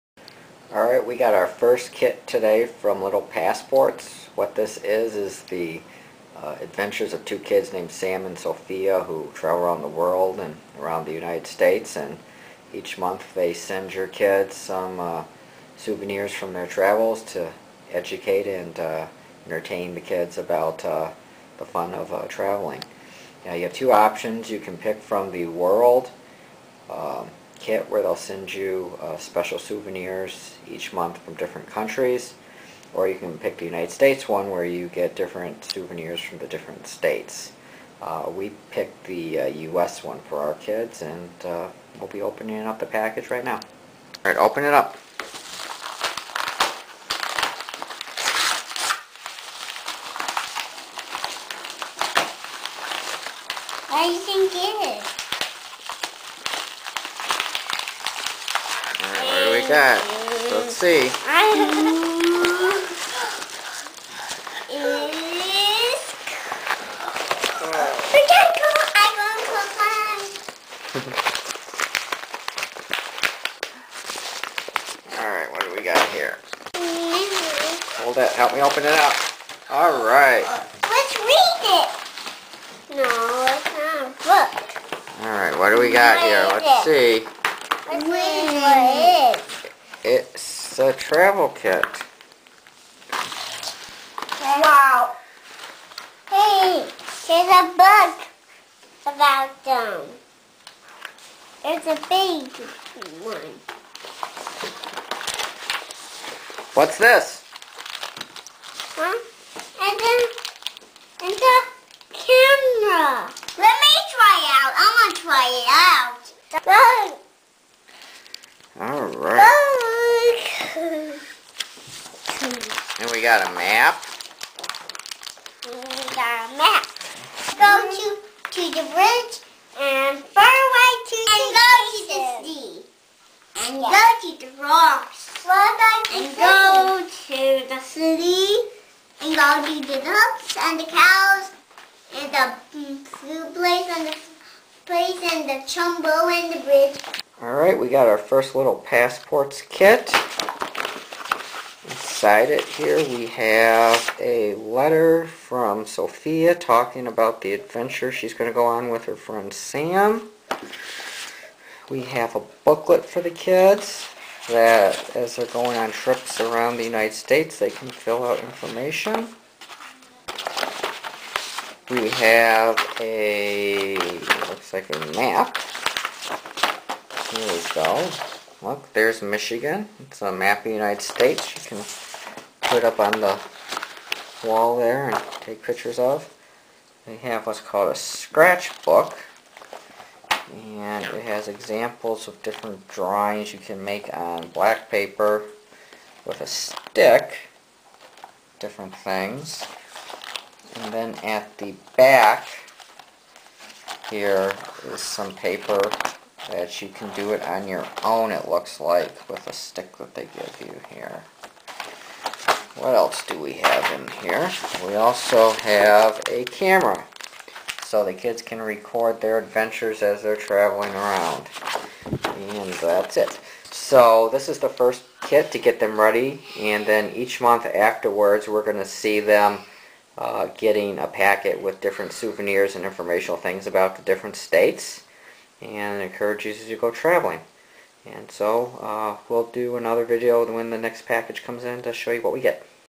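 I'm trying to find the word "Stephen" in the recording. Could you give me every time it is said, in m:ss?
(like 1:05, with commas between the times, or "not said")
not said.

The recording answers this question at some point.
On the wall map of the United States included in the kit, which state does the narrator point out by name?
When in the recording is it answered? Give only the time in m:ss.
2:59.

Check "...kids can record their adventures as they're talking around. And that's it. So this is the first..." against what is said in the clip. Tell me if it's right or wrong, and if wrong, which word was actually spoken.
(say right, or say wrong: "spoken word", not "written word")
wrong: "traveling", not "talking".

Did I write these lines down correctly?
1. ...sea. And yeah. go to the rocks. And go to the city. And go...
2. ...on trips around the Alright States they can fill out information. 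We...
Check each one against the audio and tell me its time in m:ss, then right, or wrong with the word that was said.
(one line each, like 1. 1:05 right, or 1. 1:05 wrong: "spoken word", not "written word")
1. 2:12 right
2. 2:45 wrong: "United", not "Alright".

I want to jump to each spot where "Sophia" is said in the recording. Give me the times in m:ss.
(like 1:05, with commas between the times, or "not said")
0:08, 2:35.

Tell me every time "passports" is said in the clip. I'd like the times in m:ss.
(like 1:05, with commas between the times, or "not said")
0:03, 2:28.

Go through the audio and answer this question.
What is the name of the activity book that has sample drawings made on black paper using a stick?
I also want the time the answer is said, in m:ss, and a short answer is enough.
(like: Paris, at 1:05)
scratchbook, at 3:07.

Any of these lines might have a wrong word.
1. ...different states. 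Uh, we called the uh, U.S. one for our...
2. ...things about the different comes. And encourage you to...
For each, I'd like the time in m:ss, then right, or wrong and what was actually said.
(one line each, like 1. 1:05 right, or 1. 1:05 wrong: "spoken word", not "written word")
1. 0:36 wrong: "picked", not "called"
2. 3:53 wrong: "states", not "comes".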